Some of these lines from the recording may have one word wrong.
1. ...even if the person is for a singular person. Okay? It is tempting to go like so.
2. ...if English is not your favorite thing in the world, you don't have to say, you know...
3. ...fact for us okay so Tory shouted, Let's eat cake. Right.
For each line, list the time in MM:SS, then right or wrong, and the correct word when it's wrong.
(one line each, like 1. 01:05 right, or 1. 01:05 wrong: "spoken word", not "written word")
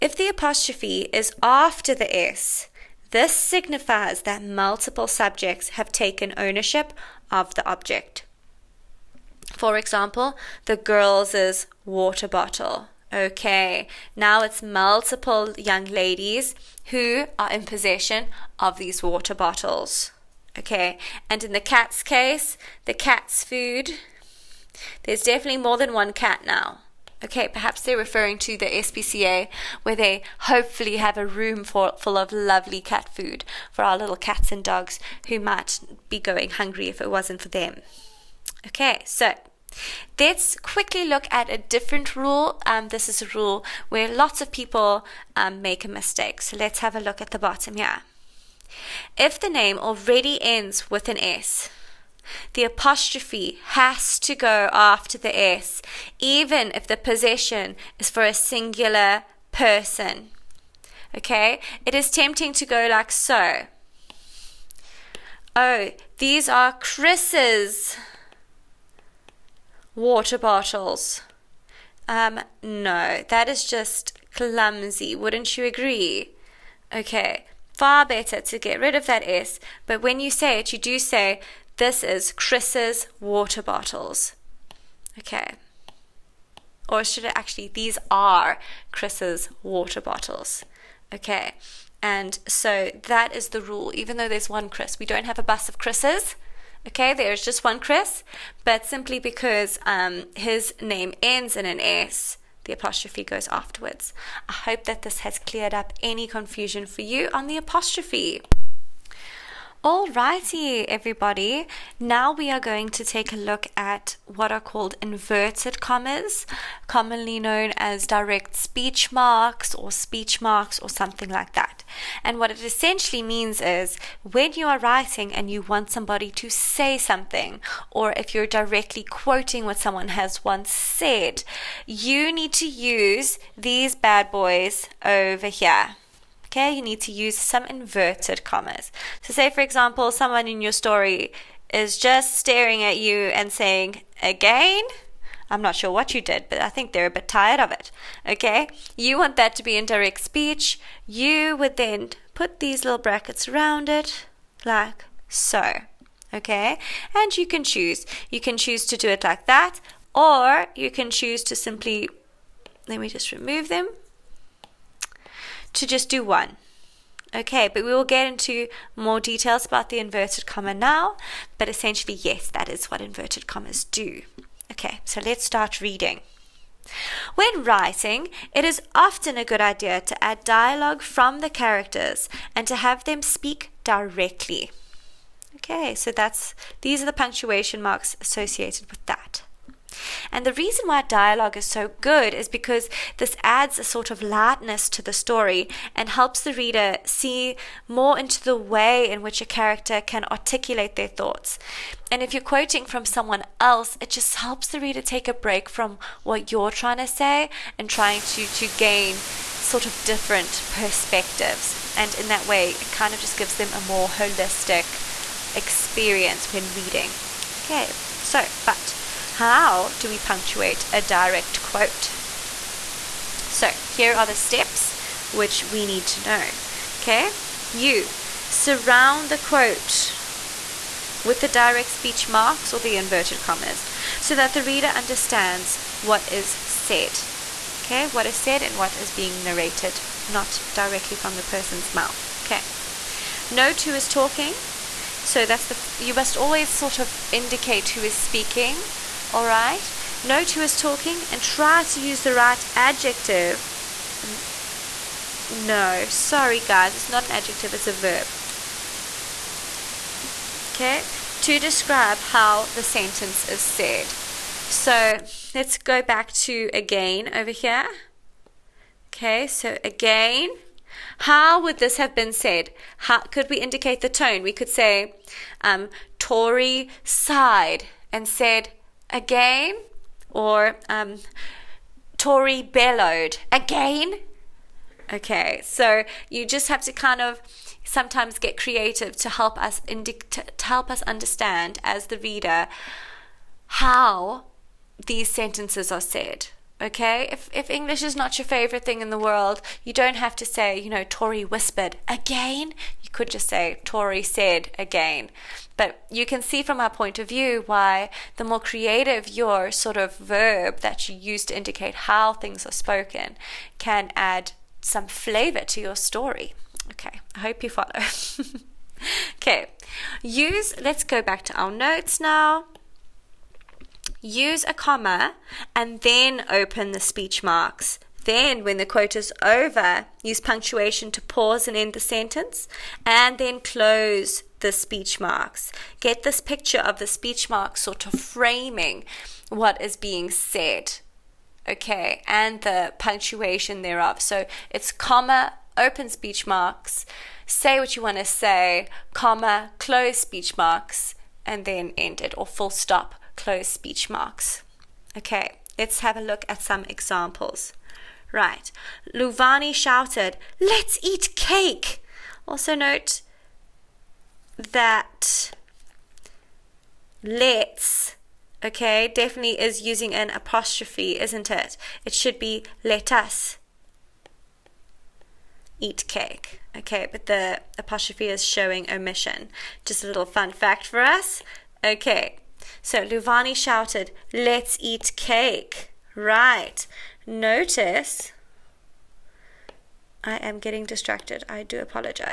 1. 00:56 wrong: "possession", not "person"
2. 04:57 right
3. 06:20 wrong: "Luvani", not "Tory".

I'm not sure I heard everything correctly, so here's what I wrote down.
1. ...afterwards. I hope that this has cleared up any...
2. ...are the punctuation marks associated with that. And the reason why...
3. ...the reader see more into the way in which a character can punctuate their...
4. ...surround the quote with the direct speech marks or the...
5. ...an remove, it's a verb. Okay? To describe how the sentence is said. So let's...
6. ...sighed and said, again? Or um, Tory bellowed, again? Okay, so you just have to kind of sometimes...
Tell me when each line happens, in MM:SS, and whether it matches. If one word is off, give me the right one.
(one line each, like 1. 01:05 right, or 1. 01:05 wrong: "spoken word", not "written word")
1. 01:43 right
2. 03:07 right
3. 03:16 wrong: "articulate", not "punctuate"
4. 03:48 right
5. 04:17 wrong: "adjective", not "remove"
6. 04:37 right.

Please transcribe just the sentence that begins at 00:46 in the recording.
So let's have a look at the bottom here.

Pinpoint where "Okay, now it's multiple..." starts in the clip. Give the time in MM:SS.
00:13.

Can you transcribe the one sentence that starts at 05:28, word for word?
Then, when the quote is over, use punctuation to pause and end the sentence, and then close the speech marks.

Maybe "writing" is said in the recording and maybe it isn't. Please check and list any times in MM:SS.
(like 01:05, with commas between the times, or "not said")
02:04, 02:57.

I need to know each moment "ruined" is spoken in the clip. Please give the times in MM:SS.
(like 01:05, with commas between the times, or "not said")
not said.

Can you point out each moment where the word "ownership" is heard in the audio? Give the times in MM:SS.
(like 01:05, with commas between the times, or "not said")
00:06.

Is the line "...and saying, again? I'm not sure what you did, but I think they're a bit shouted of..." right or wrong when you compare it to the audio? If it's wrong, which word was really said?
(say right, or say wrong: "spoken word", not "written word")
wrong: "tired", not "shouted".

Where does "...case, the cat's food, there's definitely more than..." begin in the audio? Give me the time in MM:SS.
00:22.